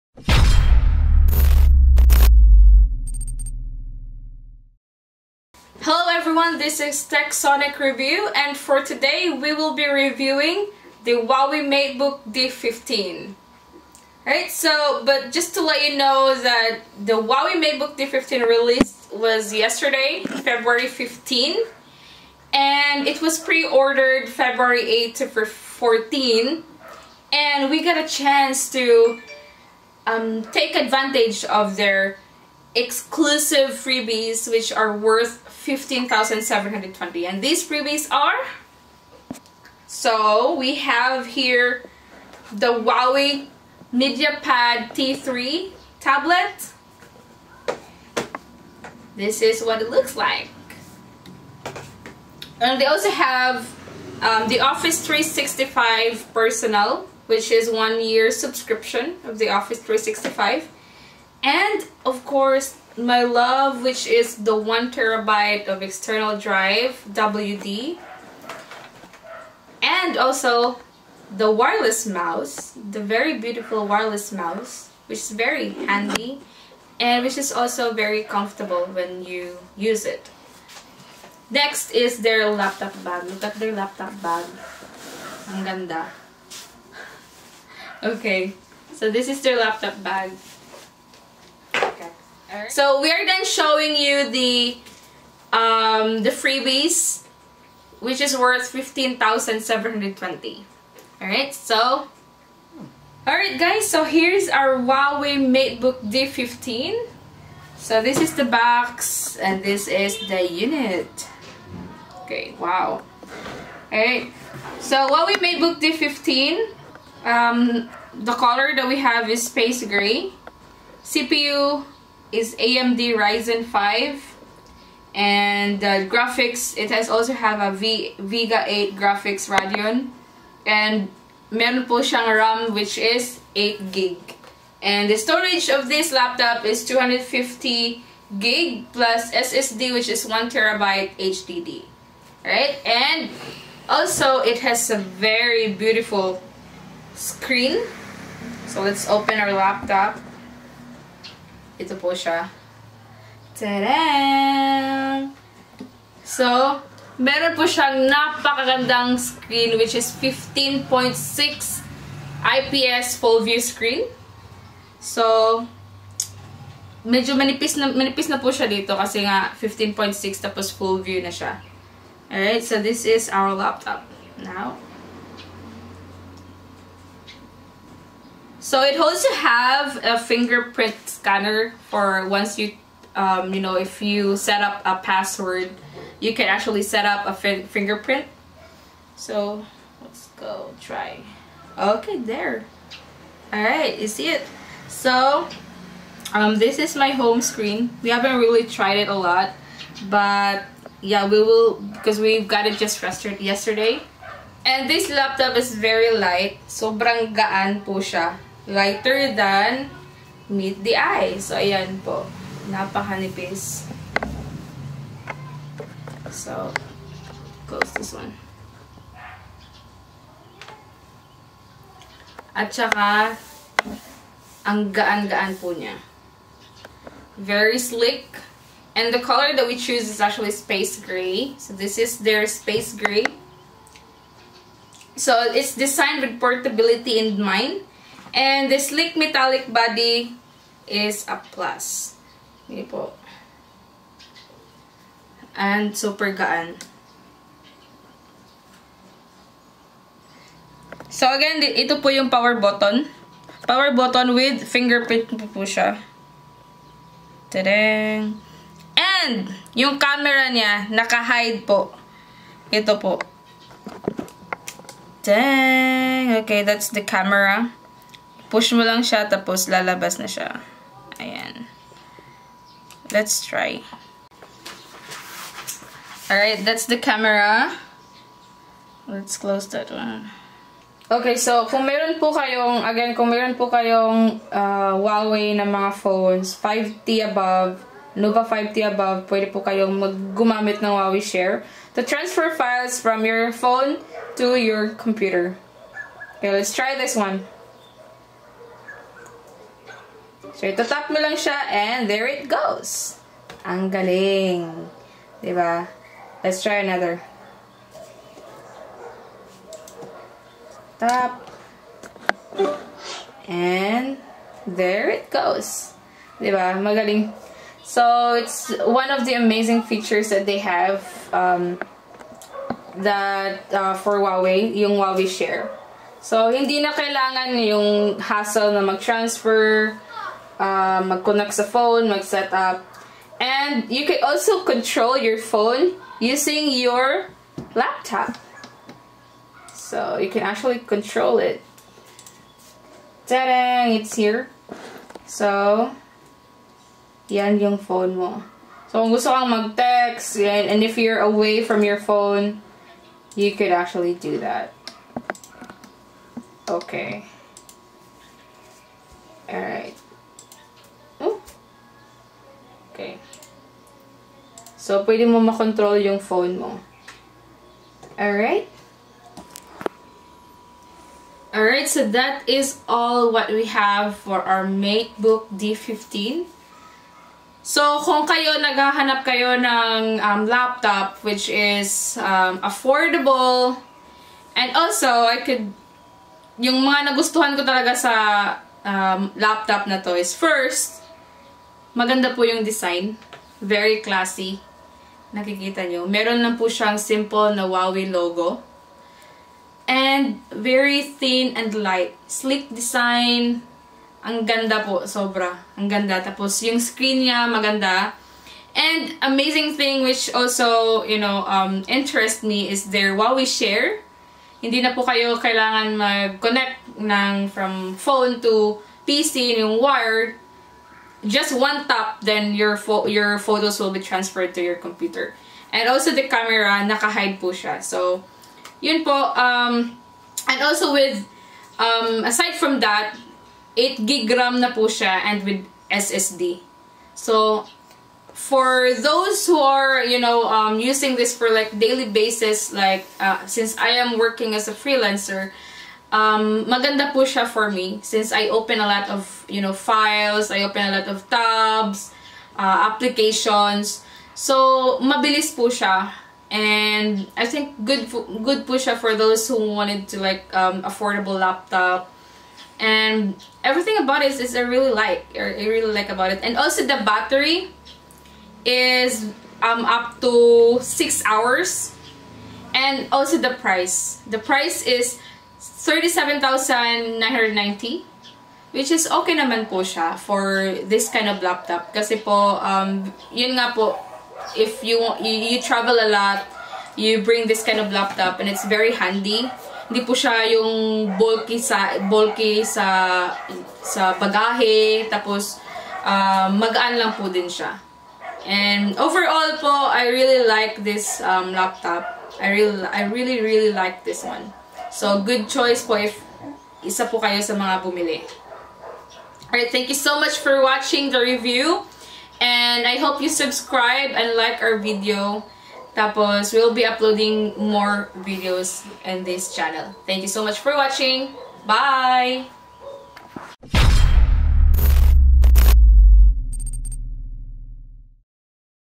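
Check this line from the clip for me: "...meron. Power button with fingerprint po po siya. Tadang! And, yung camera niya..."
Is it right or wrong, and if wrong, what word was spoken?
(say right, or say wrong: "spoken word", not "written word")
wrong: "button", not "meron".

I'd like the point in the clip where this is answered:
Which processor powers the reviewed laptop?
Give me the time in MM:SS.
02:02.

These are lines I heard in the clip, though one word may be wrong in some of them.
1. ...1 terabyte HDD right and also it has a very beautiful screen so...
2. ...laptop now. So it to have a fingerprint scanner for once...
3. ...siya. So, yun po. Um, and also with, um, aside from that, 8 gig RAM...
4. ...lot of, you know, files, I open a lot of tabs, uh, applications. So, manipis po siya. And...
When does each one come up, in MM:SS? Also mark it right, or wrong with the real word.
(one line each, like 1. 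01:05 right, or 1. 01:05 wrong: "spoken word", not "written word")
1. 02:20 right
2. 02:53 right
3. 07:07 right
4. 07:28 wrong: "mabilis", not "manipis".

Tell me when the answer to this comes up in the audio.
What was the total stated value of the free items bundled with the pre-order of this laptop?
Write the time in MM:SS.
00:35.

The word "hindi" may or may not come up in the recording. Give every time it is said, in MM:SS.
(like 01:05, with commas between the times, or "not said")
04:02, 05:26, 06:54, 08:09.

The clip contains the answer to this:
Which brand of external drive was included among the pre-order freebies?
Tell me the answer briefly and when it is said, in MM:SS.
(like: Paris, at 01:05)
WD, at 01:07.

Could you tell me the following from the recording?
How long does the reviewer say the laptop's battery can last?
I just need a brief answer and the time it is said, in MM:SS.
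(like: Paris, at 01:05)
up to 6 hours, at 07:49.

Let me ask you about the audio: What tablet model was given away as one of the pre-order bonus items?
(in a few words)
Huawei MediaPad T3.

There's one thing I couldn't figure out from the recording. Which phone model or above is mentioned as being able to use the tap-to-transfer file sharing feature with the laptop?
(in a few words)
Nova 5T.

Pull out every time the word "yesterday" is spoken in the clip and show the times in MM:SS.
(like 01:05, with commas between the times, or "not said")
00:19, 03:23.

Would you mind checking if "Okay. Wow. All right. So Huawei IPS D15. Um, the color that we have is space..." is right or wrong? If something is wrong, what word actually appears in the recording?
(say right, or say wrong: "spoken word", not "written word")
wrong: "MateBook", not "IPS".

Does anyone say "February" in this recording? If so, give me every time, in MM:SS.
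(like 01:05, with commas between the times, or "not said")
00:20, 00:24.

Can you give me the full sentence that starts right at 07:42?
And everything about it is I really like.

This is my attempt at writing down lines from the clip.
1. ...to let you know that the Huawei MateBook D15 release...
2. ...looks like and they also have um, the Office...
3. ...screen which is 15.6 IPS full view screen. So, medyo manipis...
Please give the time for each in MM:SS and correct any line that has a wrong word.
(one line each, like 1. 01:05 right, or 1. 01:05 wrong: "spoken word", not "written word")
1. 00:15 right
2. 00:49 right
3. 02:39 right.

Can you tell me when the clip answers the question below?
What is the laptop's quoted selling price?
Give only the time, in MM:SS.
07:55.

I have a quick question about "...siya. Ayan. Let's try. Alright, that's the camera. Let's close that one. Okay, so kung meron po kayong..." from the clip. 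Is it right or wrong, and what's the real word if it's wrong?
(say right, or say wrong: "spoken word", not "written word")
right.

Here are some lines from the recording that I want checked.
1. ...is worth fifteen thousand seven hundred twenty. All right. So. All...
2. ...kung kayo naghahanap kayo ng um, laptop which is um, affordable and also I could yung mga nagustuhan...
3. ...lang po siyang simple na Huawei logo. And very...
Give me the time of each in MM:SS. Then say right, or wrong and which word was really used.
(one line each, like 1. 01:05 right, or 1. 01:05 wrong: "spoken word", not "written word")
1. 01:38 right
2. 06:18 right
3. 06:36 right.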